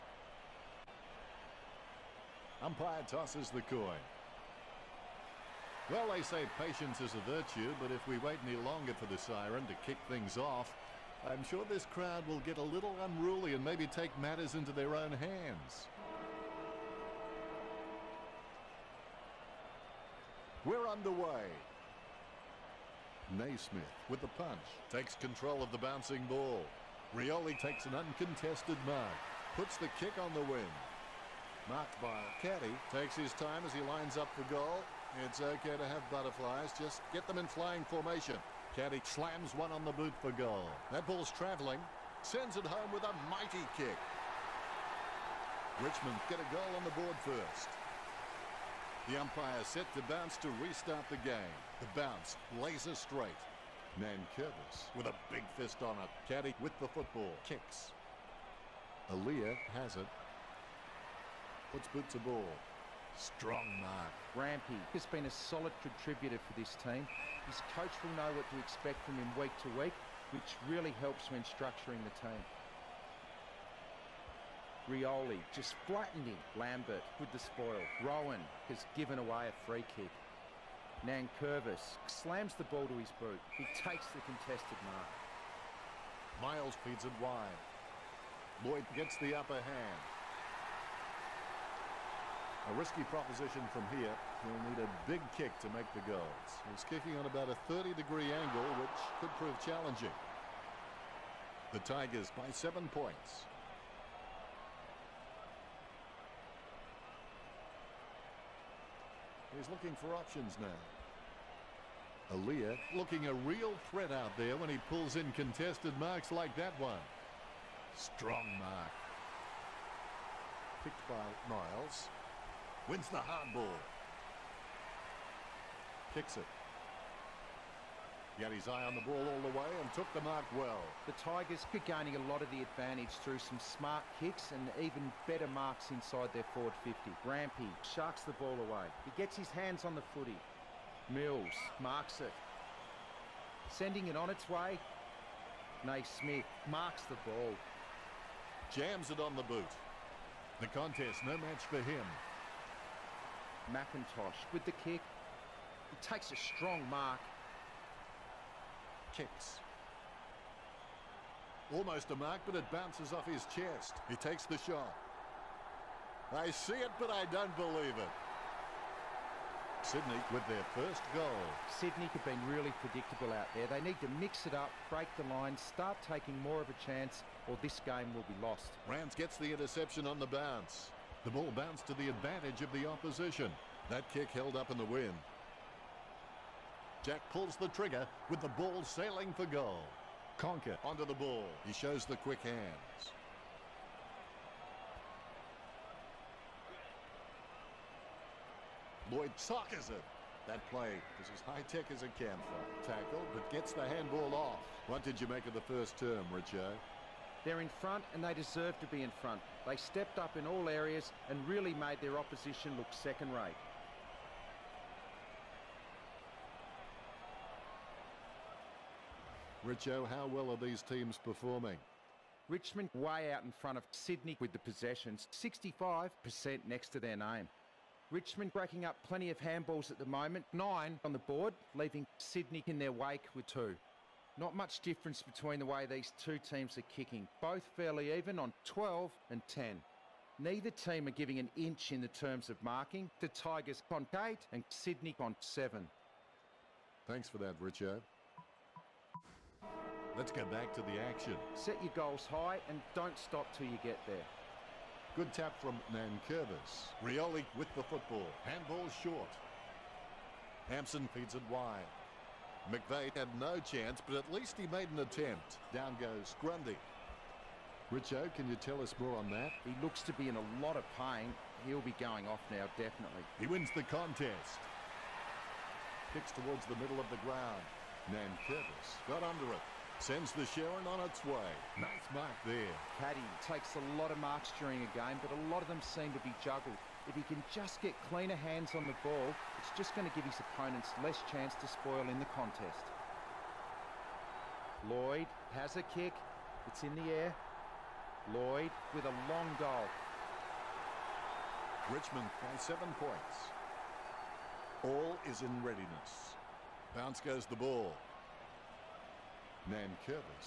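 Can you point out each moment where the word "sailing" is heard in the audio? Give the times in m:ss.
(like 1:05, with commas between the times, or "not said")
3:08.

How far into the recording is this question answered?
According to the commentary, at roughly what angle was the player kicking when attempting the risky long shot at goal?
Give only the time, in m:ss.
1:37.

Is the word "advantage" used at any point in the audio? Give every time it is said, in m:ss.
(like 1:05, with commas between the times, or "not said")
2:12, 3:02.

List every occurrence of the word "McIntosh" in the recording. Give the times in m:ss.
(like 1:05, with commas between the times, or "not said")
2:33.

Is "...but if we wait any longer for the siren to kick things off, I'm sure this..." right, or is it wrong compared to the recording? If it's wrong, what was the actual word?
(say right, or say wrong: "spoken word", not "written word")
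right.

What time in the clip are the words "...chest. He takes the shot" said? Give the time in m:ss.
2:43.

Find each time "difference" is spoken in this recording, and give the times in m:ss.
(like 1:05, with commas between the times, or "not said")
3:54.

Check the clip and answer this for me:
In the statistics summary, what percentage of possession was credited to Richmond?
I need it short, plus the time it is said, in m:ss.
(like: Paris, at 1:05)
65%, at 3:45.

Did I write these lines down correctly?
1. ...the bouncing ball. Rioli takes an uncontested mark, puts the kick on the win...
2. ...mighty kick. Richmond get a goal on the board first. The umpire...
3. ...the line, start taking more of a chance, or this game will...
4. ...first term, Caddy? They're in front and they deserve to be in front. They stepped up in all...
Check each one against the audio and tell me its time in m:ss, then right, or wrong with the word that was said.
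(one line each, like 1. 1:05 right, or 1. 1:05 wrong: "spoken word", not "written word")
1. 0:25 right
2. 0:43 right
3. 2:55 right
4. 3:25 wrong: "Richard", not "Caddy".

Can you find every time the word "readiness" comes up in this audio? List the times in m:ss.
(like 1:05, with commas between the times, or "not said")
5:05.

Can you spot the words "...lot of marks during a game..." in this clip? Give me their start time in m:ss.
4:43.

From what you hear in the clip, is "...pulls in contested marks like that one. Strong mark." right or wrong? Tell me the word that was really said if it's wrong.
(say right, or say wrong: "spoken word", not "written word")
right.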